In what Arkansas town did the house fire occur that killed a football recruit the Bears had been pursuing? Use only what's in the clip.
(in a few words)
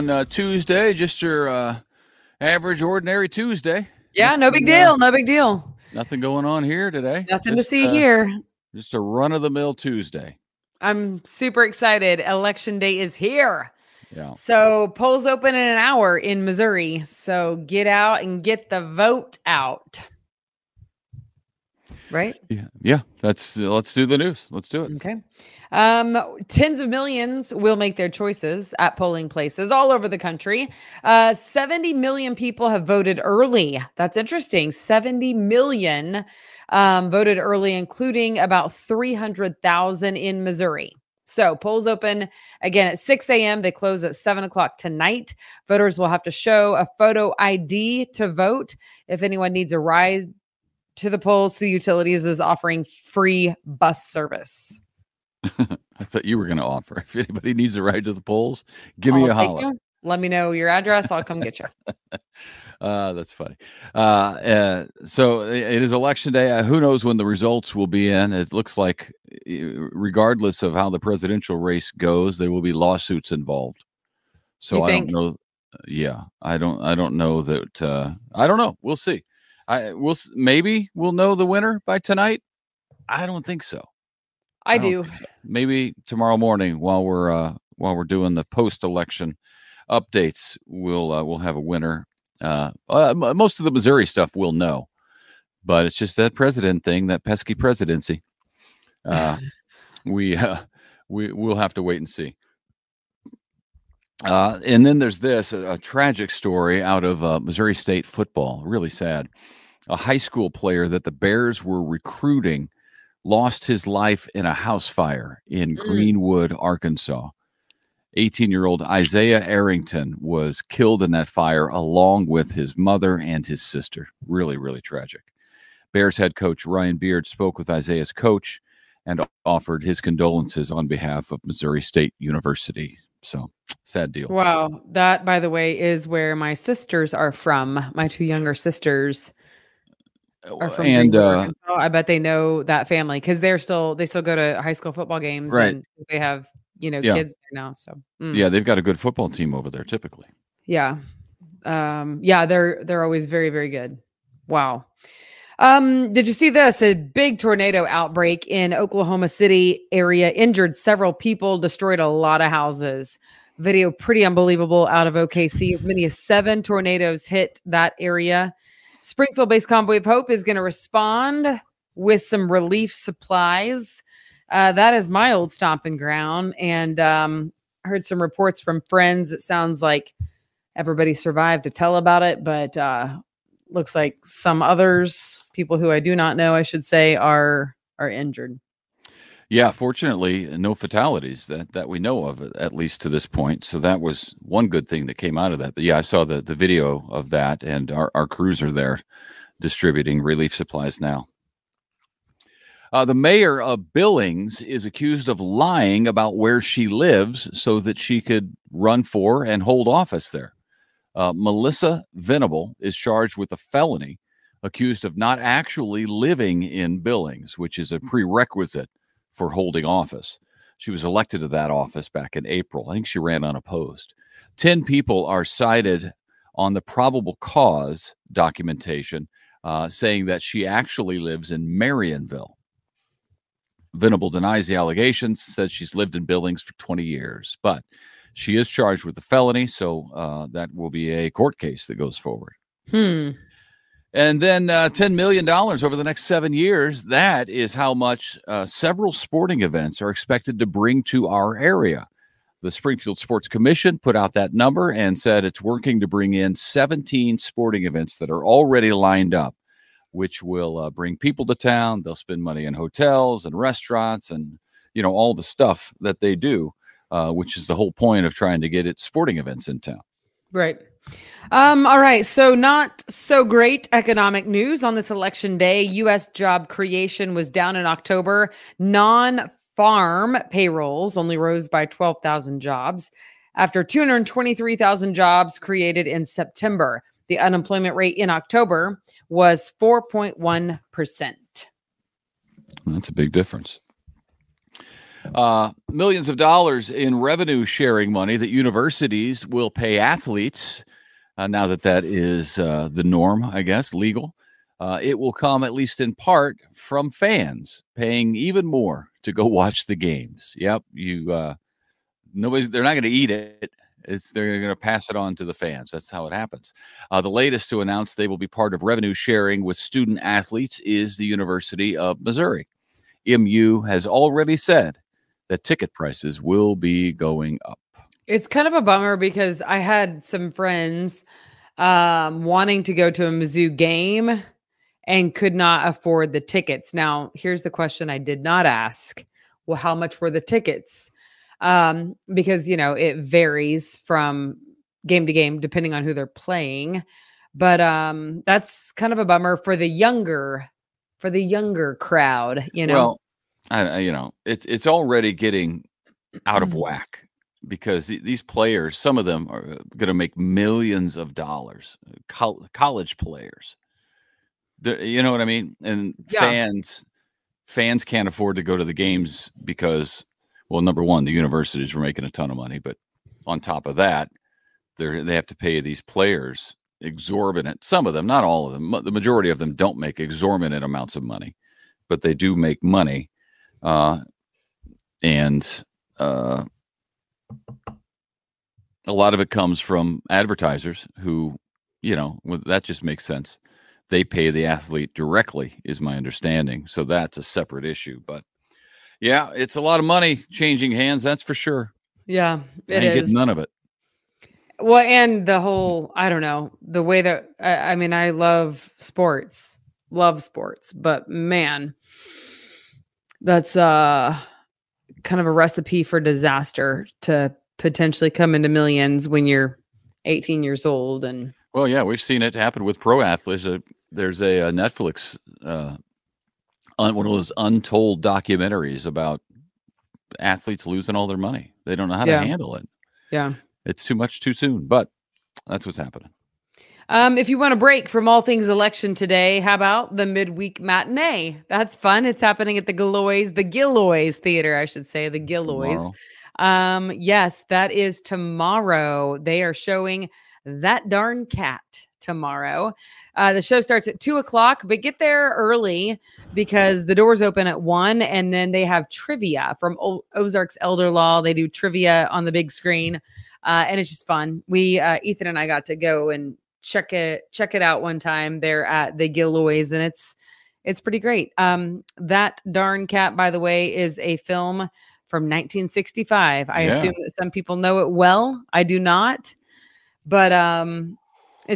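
Greenwood.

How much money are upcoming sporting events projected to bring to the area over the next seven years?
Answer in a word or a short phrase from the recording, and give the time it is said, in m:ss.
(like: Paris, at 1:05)
$10 million, at 4:04.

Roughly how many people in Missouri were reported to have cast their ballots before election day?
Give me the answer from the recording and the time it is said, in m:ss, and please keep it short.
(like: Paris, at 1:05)
300,000, at 0:38.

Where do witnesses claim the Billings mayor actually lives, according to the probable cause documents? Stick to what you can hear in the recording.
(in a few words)
Marionville.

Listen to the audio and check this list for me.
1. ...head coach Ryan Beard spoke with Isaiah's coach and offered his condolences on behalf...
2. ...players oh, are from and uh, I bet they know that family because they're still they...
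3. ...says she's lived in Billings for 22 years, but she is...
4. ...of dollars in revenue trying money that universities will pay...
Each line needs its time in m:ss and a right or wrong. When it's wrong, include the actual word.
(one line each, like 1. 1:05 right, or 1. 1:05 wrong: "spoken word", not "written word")
1. 2:06 right
2. 2:18 wrong: "sisters", not "players"
3. 3:55 wrong: "20", not "22"
4. 4:56 wrong: "sharing", not "trying".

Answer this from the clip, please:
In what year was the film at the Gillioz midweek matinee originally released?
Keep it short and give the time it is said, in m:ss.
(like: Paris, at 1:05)
1965, at 7:55.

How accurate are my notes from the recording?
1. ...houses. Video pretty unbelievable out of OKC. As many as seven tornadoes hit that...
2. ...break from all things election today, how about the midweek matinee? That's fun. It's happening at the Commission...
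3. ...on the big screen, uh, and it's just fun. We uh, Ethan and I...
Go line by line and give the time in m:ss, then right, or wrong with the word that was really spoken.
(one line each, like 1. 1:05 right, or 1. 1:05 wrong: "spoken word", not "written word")
1. 2:42 right
2. 7:17 wrong: "Gillioz", not "Commission"
3. 7:42 right.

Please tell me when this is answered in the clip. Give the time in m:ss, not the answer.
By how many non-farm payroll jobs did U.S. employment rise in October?
4:41.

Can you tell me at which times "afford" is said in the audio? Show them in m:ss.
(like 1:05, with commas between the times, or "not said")
5:35, 6:08.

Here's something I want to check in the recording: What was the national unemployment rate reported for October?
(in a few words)
4.1%.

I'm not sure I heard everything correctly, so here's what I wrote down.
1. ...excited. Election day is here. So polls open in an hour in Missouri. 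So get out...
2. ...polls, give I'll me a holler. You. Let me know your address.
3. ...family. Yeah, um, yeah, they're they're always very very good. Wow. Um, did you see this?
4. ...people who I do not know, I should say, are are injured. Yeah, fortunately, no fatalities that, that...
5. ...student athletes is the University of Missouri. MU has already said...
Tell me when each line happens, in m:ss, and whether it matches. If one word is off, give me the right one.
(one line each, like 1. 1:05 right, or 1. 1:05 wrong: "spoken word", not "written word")
1. 0:11 right
2. 0:58 right
3. 2:29 wrong: "typically", not "family"
4. 3:05 right
5. 5:19 right.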